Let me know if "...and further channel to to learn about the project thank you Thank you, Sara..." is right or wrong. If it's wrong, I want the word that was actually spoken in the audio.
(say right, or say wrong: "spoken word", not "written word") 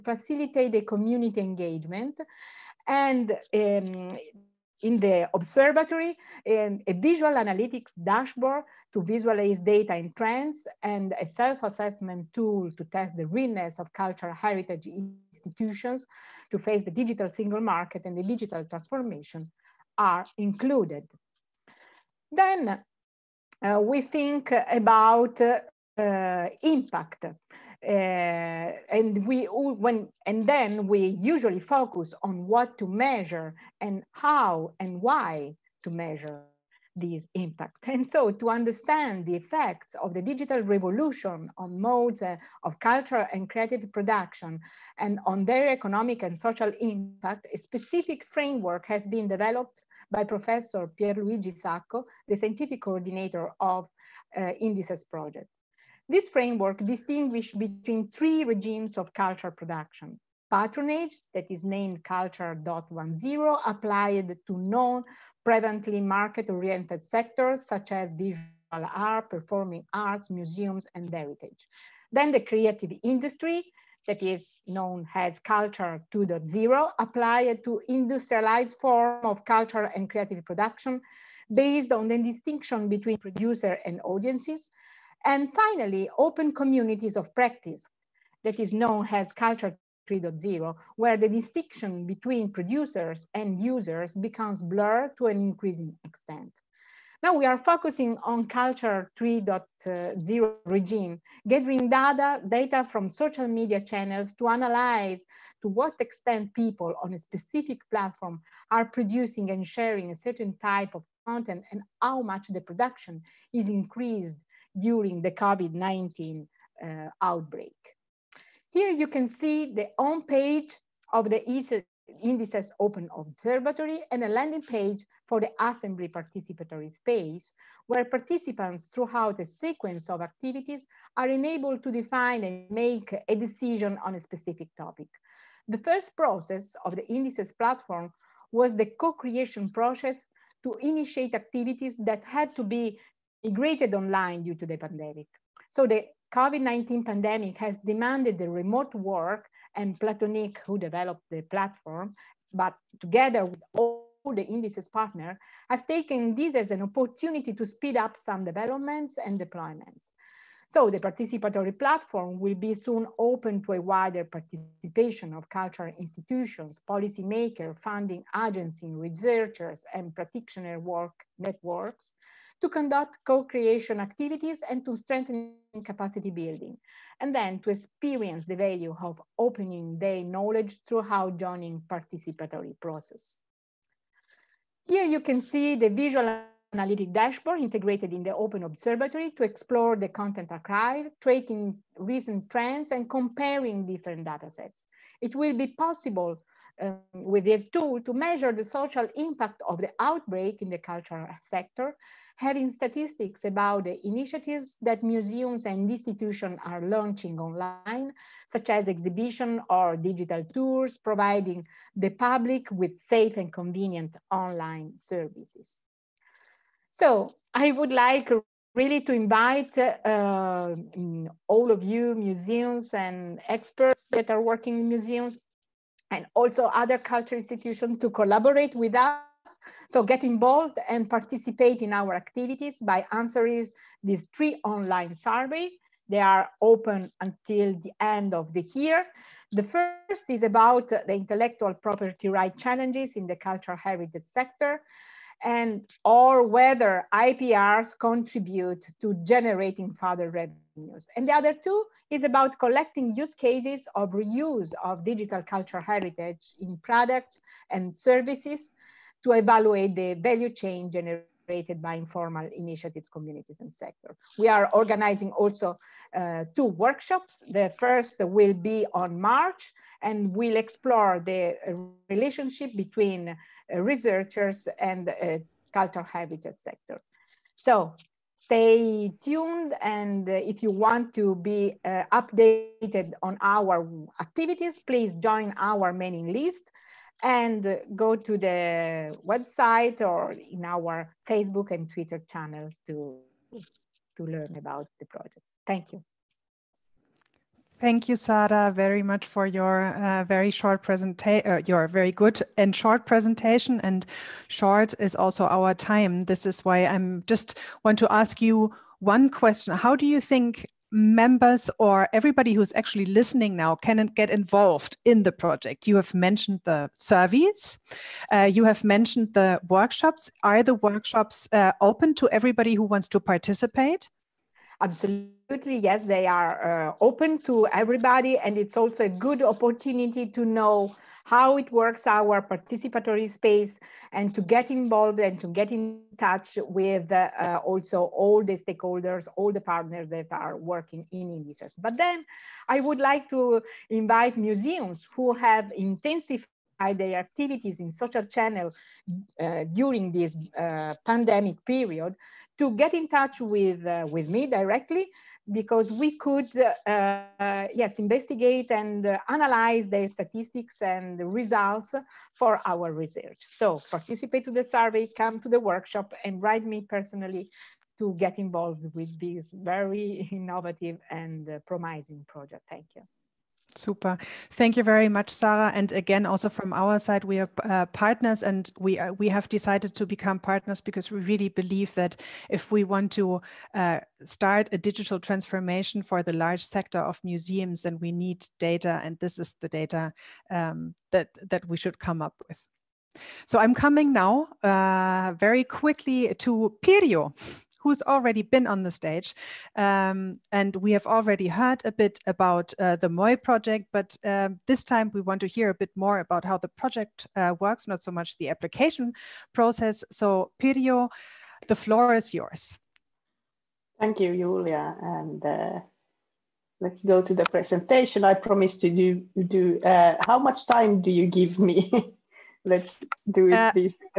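wrong: "twitter", not "further".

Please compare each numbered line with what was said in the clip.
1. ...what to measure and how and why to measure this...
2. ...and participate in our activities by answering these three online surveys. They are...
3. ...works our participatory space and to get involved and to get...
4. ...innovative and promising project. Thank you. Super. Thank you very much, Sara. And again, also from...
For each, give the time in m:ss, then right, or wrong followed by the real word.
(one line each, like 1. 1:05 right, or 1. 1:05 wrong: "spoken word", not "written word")
1. 0:32 right
2. 3:50 right
3. 5:31 right
4. 6:10 right.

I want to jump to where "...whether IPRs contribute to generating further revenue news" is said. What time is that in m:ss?
4:06.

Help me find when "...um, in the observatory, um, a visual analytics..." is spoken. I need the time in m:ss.
0:03.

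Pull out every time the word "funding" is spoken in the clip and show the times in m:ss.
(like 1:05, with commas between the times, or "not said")
2:47.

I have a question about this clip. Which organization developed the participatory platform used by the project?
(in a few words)
Platoniq.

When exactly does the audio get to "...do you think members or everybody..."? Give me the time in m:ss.
5:09.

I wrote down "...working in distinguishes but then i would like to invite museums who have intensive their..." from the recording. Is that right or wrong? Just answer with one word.
wrong.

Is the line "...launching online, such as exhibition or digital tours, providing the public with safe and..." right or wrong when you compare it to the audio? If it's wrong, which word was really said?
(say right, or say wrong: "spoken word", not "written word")
right.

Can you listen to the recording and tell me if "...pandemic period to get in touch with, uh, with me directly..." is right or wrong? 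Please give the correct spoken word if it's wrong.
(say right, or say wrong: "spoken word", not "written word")
right.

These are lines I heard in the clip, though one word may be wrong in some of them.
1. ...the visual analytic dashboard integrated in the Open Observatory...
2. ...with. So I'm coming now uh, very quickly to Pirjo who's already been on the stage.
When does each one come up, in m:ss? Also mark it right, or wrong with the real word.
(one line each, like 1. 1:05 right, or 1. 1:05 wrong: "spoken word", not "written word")
1. 3:05 right
2. 6:32 right.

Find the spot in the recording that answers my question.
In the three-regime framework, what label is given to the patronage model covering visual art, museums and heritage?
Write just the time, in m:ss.
1:02.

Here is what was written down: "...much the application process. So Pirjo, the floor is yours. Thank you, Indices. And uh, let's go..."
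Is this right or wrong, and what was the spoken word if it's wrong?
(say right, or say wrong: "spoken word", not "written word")
wrong: "Julia", not "Indices".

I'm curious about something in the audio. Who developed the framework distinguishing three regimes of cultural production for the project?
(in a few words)
Pierluigi Sacco.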